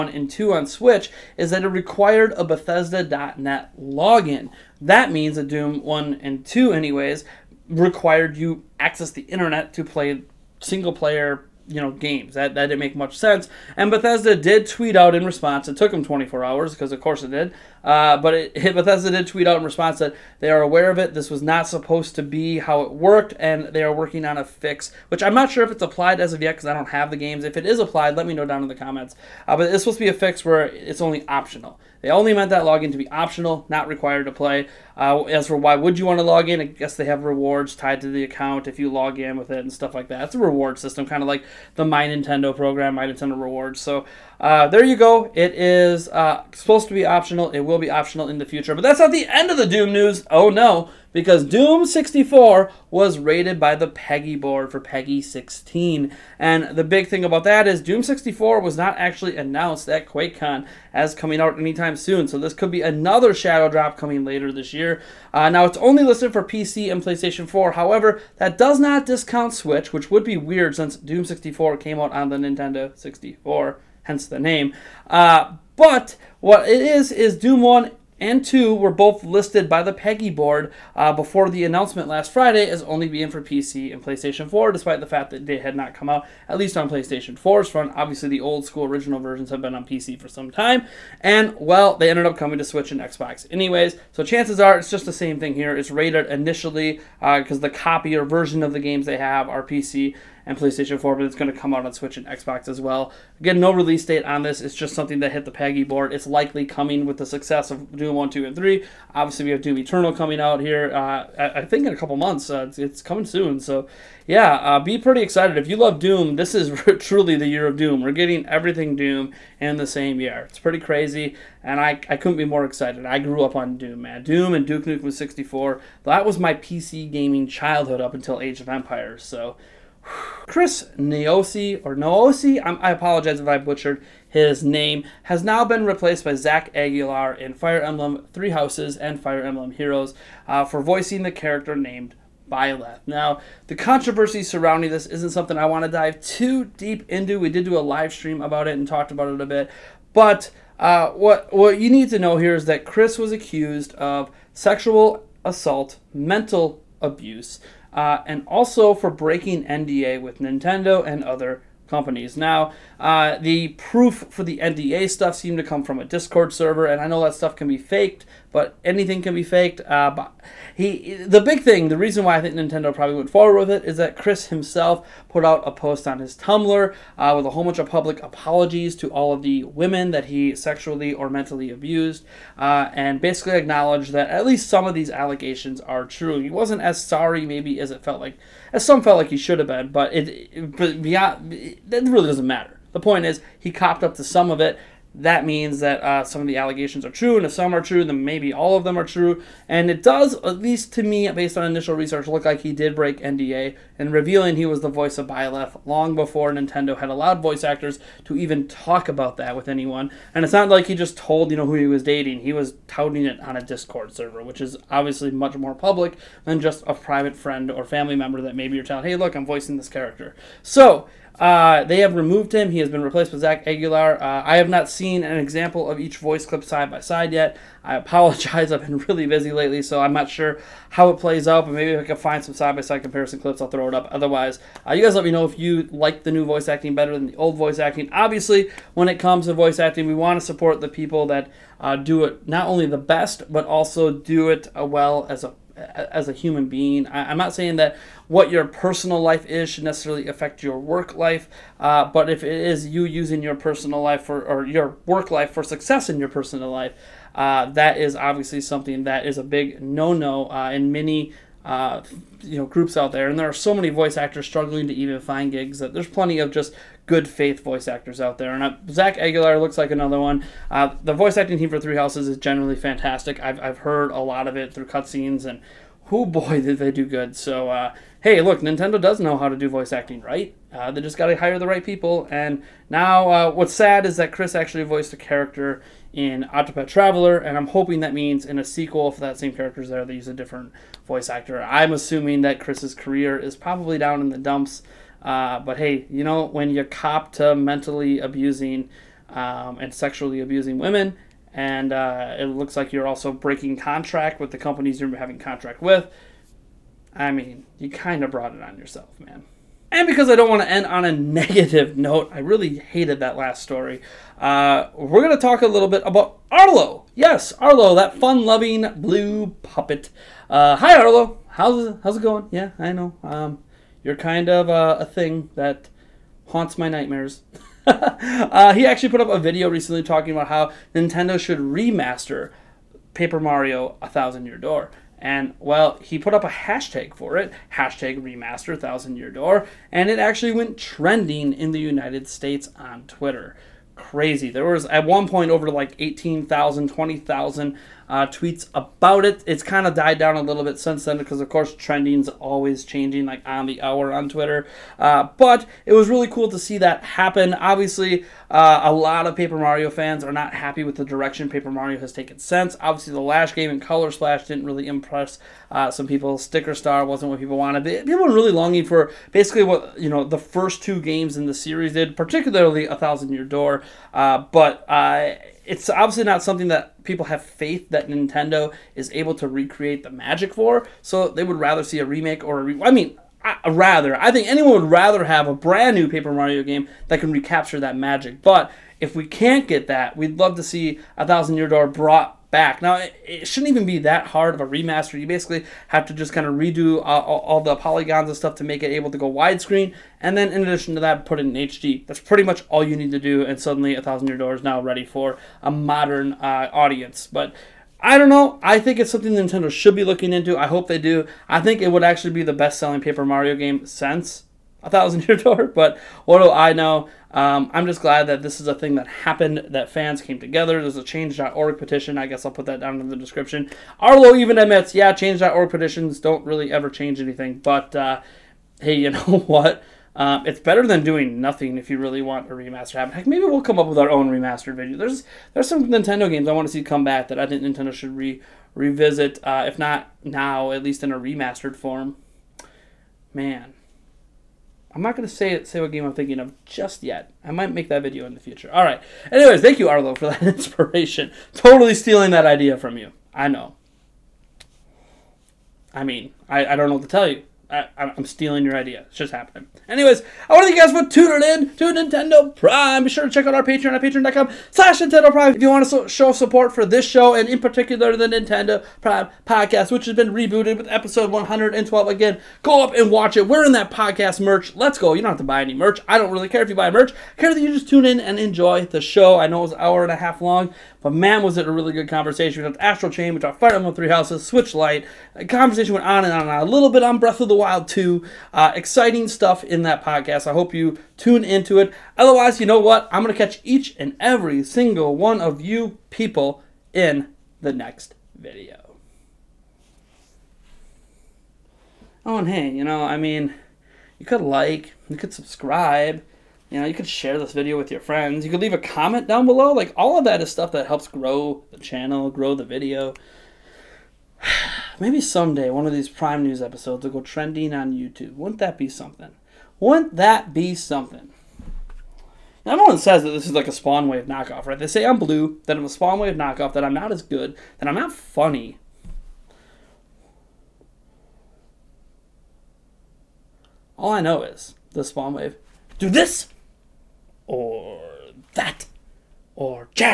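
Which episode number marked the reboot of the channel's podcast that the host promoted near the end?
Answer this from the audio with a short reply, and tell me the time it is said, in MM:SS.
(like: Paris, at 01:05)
112, at 07:50.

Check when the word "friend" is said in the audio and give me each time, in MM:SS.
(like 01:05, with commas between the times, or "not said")
03:37, 08:27.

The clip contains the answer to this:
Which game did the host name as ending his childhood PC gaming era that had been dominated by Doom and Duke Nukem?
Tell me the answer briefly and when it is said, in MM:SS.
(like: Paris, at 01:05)
Age of Empires, at 02:08.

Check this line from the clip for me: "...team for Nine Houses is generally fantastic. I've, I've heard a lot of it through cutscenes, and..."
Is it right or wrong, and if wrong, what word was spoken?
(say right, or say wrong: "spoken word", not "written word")
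wrong: "Three", not "Nine".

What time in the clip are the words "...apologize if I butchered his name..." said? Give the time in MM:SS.
02:12.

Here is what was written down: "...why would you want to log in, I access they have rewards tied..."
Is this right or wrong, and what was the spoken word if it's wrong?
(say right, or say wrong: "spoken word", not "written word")
wrong: "guess", not "access".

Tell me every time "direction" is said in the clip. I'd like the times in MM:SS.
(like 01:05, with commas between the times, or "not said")
06:01.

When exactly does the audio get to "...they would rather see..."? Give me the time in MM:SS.
06:21.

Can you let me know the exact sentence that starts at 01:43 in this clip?
Again, no release date on this.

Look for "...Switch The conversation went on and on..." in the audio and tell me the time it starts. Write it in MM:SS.
08:04.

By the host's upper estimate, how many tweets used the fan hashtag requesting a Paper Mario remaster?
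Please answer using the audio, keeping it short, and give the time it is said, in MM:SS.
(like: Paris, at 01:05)
20,000, at 05:46.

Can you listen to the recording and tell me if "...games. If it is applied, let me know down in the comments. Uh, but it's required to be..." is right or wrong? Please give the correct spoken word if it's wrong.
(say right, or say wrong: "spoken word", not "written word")
wrong: "supposed", not "required".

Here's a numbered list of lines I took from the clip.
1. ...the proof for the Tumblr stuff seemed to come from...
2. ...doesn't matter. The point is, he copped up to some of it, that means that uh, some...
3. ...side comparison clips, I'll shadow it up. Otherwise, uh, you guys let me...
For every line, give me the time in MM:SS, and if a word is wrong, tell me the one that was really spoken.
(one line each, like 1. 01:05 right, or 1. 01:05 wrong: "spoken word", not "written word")
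1. 02:43 wrong: "NDA", not "Tumblr"
2. 03:12 right
3. 03:52 wrong: "throw", not "shadow".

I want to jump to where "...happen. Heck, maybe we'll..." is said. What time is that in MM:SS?
07:12.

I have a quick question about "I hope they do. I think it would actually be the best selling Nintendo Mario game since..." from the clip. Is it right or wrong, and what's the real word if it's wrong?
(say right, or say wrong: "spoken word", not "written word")
wrong: "Paper", not "Nintendo".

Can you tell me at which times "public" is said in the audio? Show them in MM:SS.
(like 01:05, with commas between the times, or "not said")
02:57, 03:35.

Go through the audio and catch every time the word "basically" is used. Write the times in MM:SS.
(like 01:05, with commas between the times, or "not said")
03:03, 06:09, 06:35.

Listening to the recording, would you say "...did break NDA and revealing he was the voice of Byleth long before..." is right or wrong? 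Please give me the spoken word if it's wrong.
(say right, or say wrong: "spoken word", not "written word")
right.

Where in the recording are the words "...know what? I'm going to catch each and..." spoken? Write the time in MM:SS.
08:12.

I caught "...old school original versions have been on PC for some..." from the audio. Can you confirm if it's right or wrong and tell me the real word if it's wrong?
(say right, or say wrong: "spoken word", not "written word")
right.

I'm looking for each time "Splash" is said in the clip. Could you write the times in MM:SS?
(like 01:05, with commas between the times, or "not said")
06:04.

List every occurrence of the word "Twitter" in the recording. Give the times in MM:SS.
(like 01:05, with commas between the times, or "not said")
05:43, 05:54.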